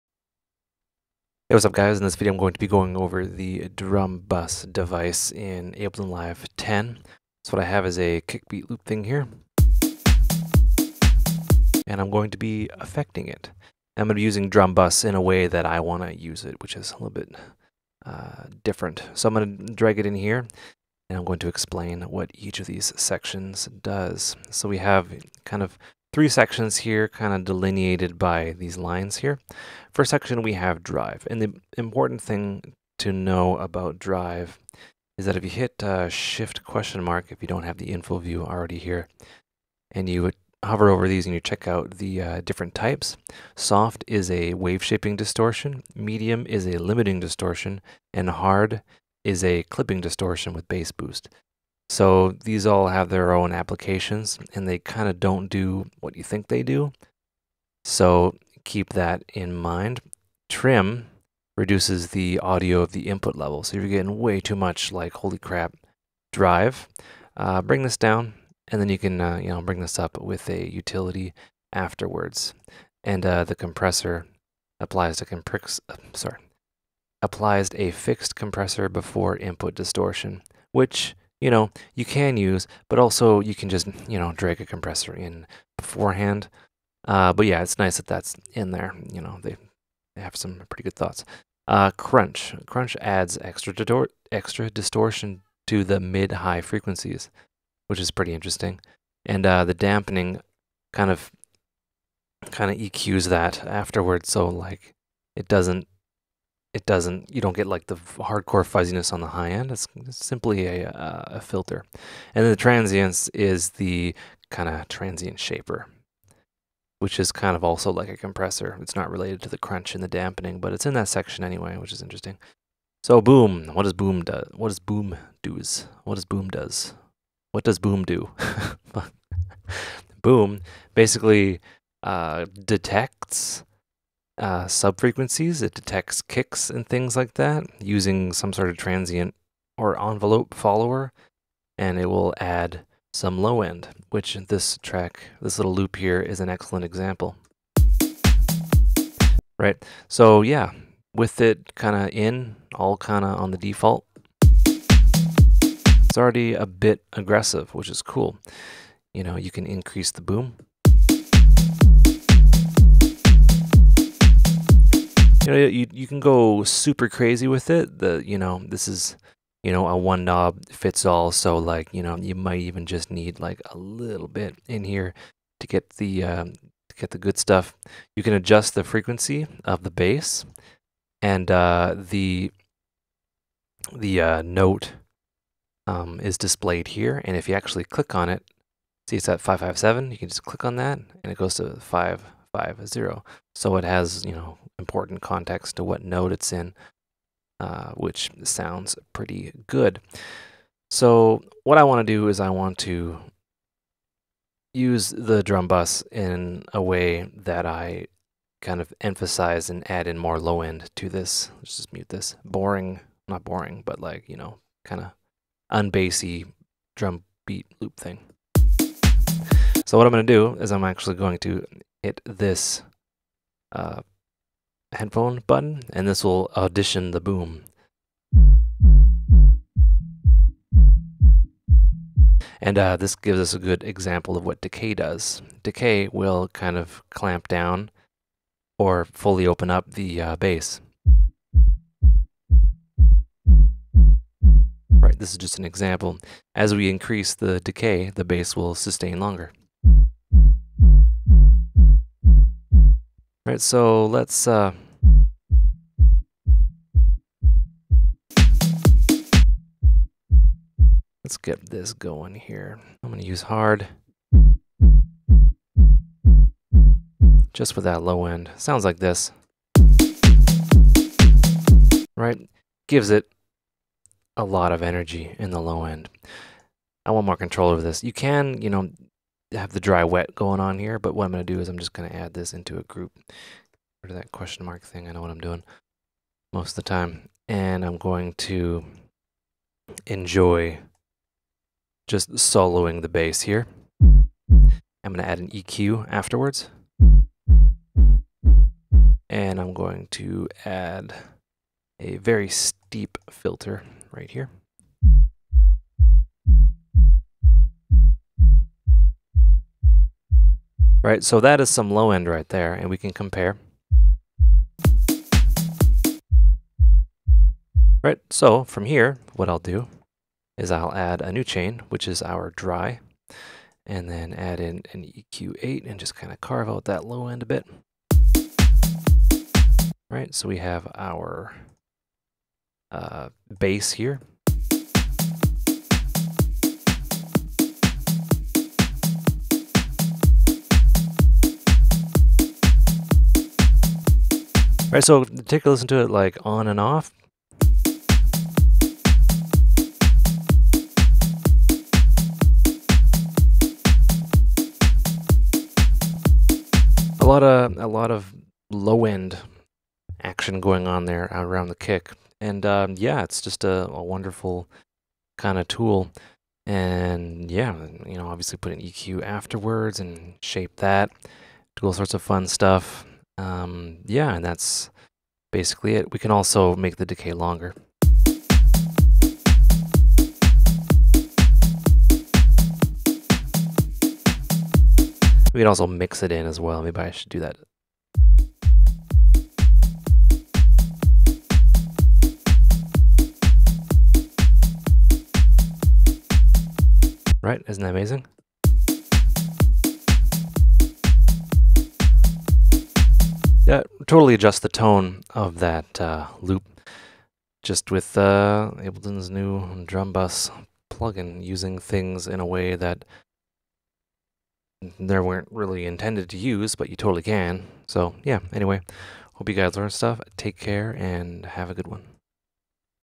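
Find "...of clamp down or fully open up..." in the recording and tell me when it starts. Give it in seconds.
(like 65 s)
236 s.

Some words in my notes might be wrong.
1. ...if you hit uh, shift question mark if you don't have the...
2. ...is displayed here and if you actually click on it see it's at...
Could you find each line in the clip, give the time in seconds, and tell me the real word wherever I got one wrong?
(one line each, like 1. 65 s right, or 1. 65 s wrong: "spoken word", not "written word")
1. 35 s right
2. 186 s right.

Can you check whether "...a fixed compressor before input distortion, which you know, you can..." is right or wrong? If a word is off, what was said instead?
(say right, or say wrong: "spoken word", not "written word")
right.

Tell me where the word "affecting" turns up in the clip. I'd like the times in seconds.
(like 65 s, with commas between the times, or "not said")
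12 s.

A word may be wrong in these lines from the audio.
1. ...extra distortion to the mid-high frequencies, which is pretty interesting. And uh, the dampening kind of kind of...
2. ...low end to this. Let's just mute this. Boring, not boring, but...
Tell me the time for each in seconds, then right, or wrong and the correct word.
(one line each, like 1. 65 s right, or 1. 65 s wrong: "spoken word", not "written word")
1. 94 s right
2. 210 s right.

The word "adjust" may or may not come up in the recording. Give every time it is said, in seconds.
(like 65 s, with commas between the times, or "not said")
178 s, 404 s.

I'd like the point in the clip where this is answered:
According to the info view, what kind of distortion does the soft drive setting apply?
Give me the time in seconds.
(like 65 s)
44 s.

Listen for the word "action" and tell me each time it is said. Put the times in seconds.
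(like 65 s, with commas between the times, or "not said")
360 s.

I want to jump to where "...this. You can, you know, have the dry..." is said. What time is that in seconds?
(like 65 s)
277 s.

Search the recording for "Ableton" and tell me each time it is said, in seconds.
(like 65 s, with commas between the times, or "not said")
5 s, 408 s.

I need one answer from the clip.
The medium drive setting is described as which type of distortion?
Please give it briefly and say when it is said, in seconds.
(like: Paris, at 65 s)
Limiting distortion, at 46 s.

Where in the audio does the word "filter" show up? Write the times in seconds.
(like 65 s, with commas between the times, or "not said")
111 s, 303 s.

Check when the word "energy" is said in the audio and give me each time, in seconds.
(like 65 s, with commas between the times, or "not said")
274 s.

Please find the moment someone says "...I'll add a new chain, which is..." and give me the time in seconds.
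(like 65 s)
320 s.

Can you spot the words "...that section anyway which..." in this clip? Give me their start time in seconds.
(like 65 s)
120 s.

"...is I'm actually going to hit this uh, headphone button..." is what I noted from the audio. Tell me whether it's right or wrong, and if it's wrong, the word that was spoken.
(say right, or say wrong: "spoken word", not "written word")
right.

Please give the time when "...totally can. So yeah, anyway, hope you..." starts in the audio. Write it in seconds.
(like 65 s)
416 s.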